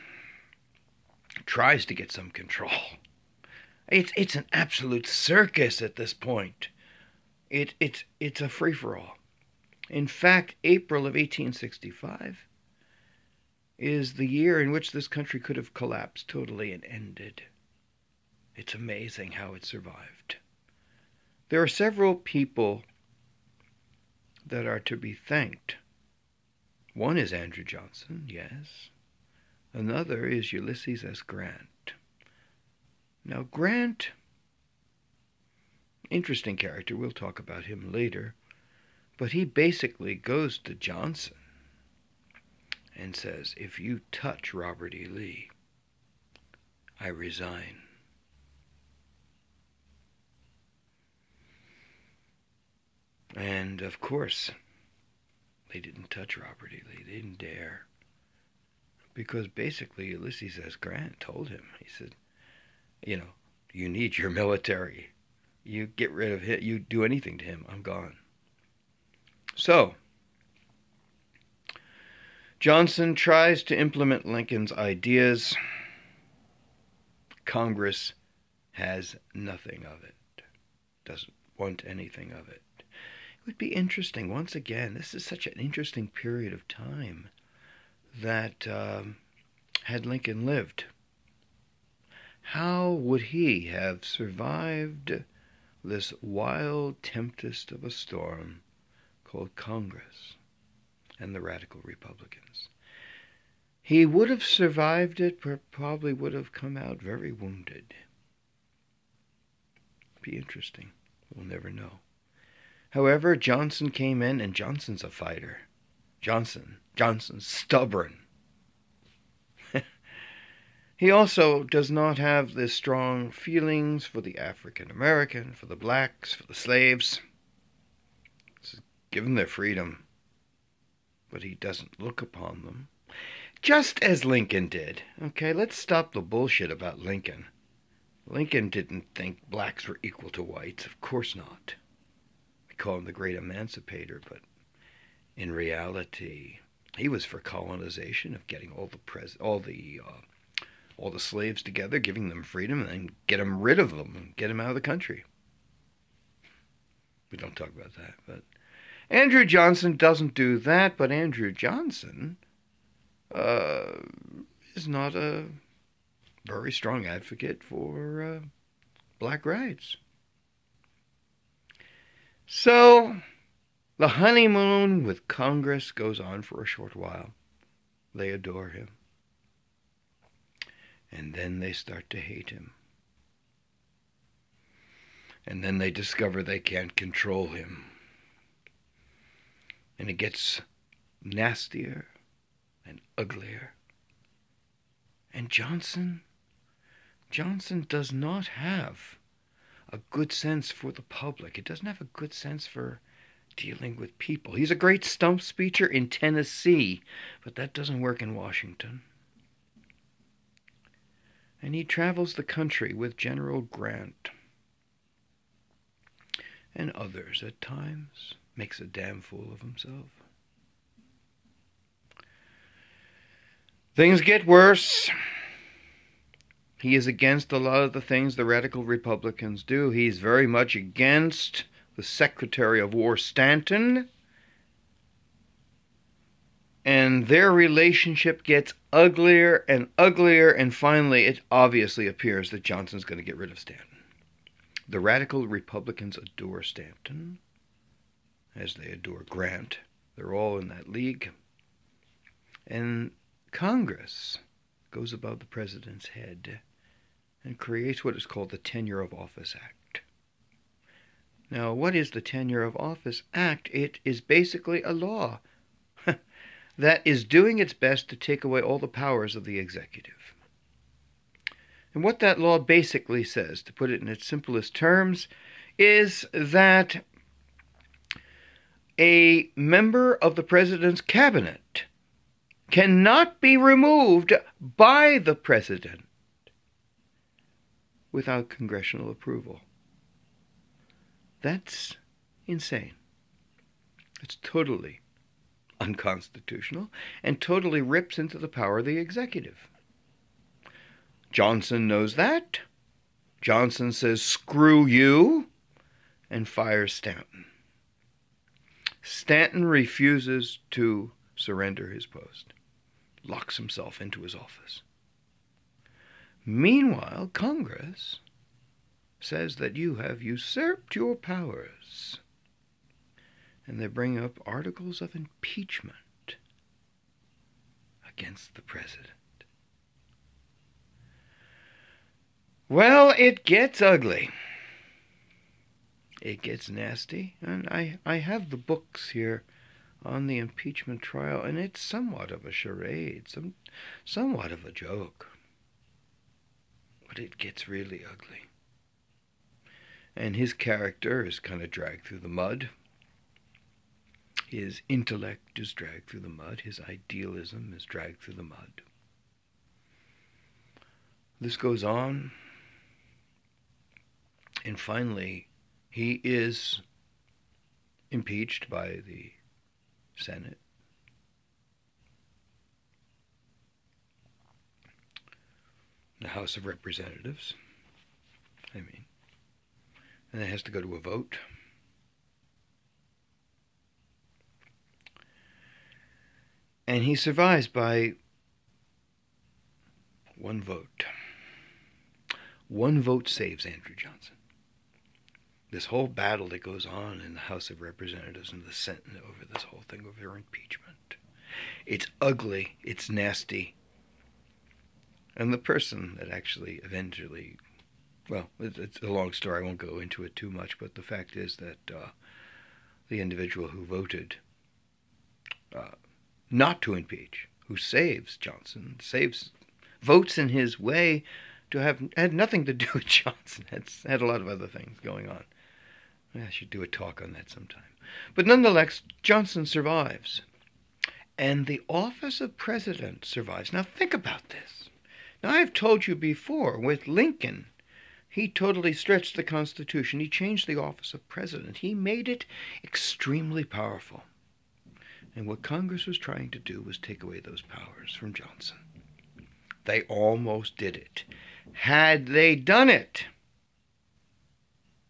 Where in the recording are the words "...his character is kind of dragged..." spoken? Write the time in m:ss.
5:50.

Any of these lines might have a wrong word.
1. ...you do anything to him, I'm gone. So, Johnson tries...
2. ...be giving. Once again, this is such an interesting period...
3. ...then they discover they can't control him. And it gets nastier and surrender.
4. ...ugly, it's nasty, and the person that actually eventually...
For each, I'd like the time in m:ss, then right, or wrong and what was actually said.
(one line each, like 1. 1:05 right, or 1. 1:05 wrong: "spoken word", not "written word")
1. 1:06 right
2. 1:23 wrong: "interesting", not "giving"
3. 3:05 wrong: "uglier", not "surrender"
4. 6:42 right.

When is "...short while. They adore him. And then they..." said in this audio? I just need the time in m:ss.
2:56.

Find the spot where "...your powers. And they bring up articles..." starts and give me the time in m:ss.
5:20.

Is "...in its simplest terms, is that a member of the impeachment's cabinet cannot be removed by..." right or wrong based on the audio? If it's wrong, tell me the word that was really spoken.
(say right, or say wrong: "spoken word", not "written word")
wrong: "president", not "impeachment".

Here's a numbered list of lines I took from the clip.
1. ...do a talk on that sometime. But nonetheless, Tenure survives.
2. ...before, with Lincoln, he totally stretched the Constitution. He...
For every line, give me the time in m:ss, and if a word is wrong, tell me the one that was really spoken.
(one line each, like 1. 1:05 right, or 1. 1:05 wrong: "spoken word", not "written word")
1. 7:06 wrong: "Johnson", not "Tenure"
2. 7:16 right.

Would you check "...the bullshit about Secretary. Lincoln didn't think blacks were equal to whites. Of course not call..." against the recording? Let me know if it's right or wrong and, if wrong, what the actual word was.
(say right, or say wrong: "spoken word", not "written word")
wrong: "Lincoln", not "Secretary".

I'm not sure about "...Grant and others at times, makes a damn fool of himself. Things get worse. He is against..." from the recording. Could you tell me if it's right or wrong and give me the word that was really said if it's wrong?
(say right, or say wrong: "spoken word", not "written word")
right.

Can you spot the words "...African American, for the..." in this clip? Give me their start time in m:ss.
2:04.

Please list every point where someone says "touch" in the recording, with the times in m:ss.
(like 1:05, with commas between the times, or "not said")
0:44, 0:56.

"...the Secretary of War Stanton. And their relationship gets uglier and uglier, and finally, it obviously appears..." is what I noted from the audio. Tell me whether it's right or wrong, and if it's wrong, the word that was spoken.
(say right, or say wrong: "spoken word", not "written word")
right.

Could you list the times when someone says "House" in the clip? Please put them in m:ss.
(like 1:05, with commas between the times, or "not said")
6:16, 6:37.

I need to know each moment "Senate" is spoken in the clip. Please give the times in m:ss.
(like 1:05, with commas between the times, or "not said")
6:10, 6:38.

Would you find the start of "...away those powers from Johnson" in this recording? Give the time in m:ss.
7:27.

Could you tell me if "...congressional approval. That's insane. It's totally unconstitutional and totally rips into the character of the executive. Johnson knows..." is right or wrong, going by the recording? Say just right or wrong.
wrong.